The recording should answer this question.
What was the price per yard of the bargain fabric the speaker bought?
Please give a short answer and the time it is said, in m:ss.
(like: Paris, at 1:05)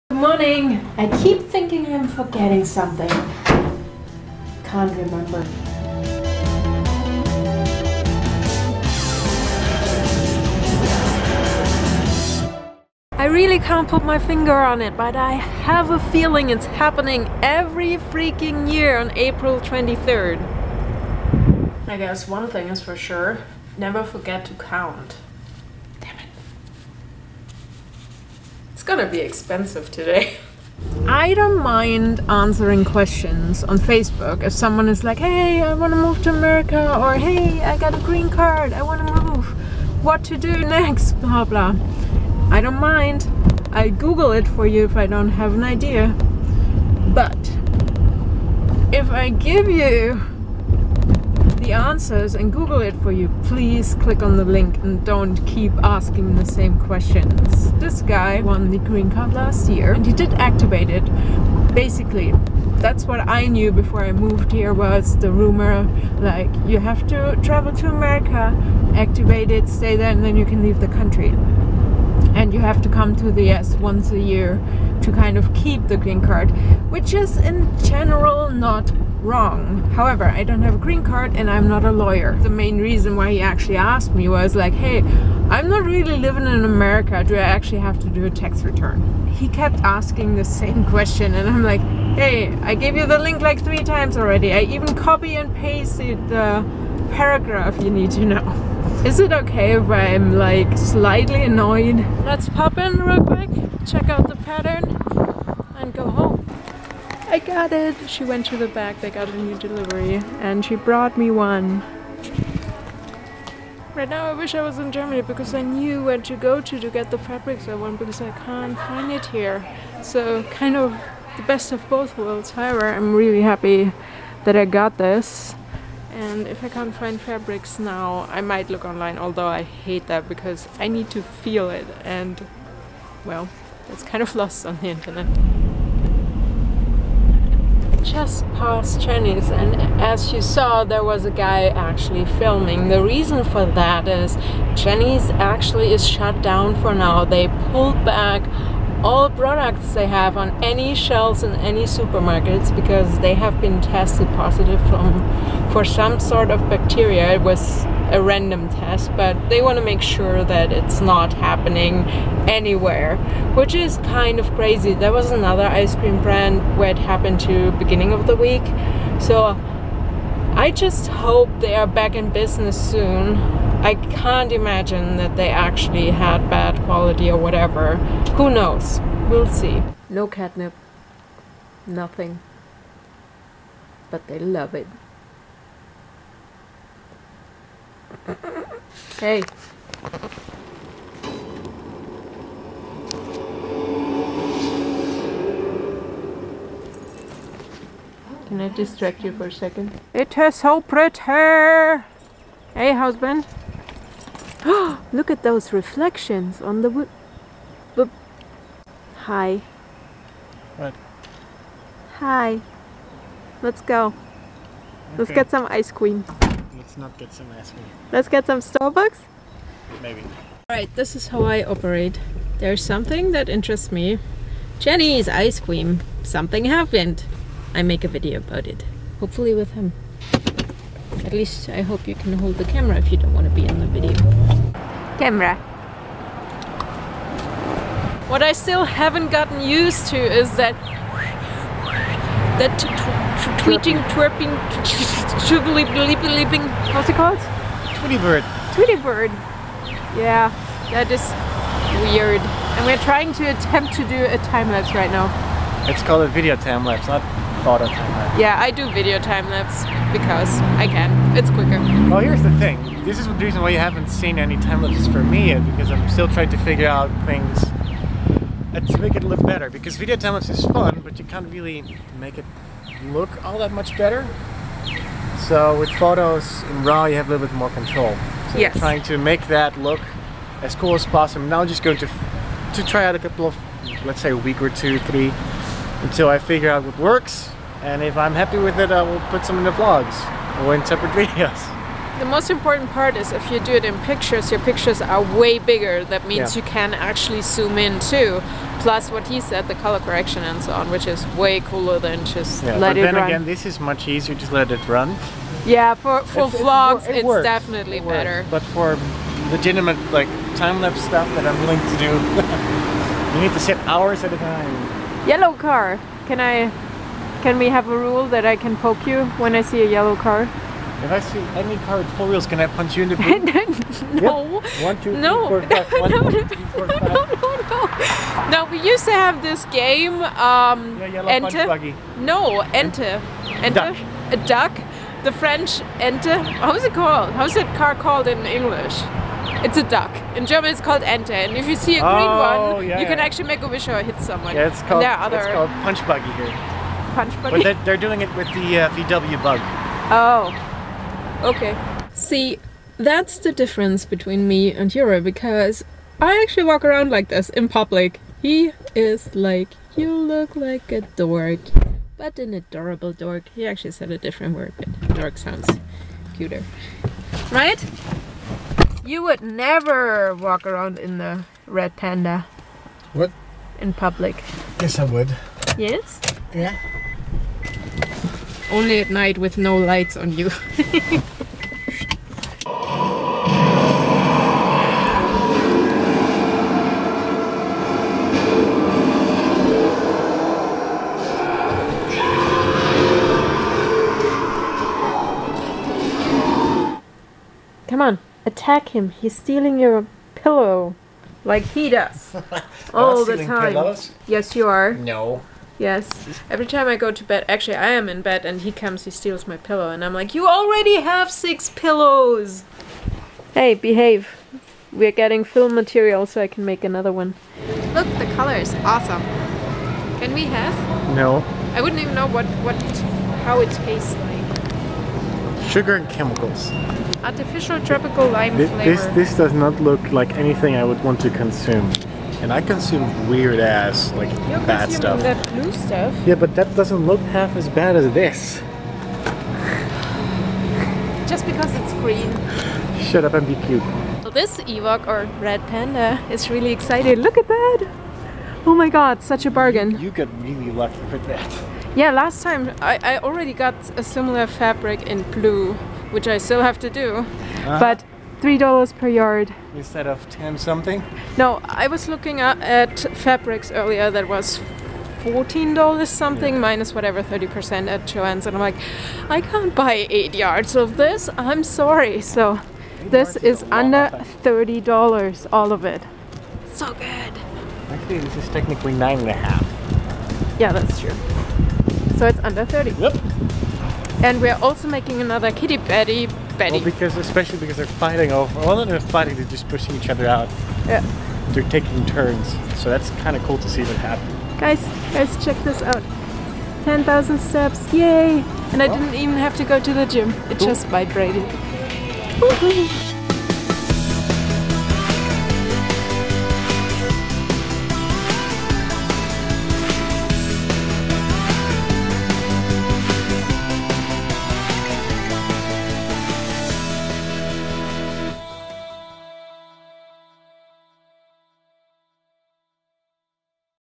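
3 dollars, at 7:38.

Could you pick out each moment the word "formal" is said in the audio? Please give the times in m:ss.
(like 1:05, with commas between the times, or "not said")
not said.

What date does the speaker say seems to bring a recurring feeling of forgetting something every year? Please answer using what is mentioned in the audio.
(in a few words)
April 23rd.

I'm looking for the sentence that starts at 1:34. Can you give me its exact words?
I even copy and pasted the paragraph you need to know.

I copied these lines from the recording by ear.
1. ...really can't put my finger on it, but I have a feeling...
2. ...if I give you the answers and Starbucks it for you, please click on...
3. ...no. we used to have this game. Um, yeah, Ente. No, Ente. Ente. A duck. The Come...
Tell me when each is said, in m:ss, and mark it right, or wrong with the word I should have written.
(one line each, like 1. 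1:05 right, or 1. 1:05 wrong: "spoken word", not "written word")
1. 0:13 right
2. 0:48 wrong: "Google", not "Starbucks"
3. 5:28 wrong: "French", not "Come".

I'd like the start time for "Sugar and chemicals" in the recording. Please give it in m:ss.
7:05.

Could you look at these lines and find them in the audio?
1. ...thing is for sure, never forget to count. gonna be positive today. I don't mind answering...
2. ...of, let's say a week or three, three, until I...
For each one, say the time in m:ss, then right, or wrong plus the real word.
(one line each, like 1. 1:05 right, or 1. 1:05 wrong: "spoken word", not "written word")
1. 0:22 wrong: "expensive", not "positive"
2. 4:43 wrong: "two", not "three".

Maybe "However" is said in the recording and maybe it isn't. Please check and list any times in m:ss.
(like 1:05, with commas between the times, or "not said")
1:19, 2:02.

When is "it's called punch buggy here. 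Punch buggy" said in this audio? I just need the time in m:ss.
5:45.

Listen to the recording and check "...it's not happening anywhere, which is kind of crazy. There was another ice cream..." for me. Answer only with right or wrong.
right.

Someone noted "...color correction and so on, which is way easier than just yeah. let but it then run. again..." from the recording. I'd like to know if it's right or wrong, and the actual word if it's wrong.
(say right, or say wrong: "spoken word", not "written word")
wrong: "cooler", not "easier".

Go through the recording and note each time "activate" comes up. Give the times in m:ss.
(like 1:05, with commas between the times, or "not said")
1:00, 1:08.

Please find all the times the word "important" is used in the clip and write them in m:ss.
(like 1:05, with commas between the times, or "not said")
4:52.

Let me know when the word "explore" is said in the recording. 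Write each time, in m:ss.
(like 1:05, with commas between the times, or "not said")
not said.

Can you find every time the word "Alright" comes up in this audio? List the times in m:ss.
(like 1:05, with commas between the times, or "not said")
3:40.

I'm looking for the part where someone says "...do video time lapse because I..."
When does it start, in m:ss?
4:18.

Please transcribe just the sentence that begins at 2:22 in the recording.
The reason for that is Jeni's actually is shut down for now.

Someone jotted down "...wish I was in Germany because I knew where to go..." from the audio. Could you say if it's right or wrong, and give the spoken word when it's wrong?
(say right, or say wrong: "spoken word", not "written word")
right.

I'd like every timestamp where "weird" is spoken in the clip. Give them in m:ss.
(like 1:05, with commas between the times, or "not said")
4:12, 7:13.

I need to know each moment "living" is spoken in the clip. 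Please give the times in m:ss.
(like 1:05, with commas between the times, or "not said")
1:26.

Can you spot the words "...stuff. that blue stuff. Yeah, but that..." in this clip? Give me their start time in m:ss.
7:14.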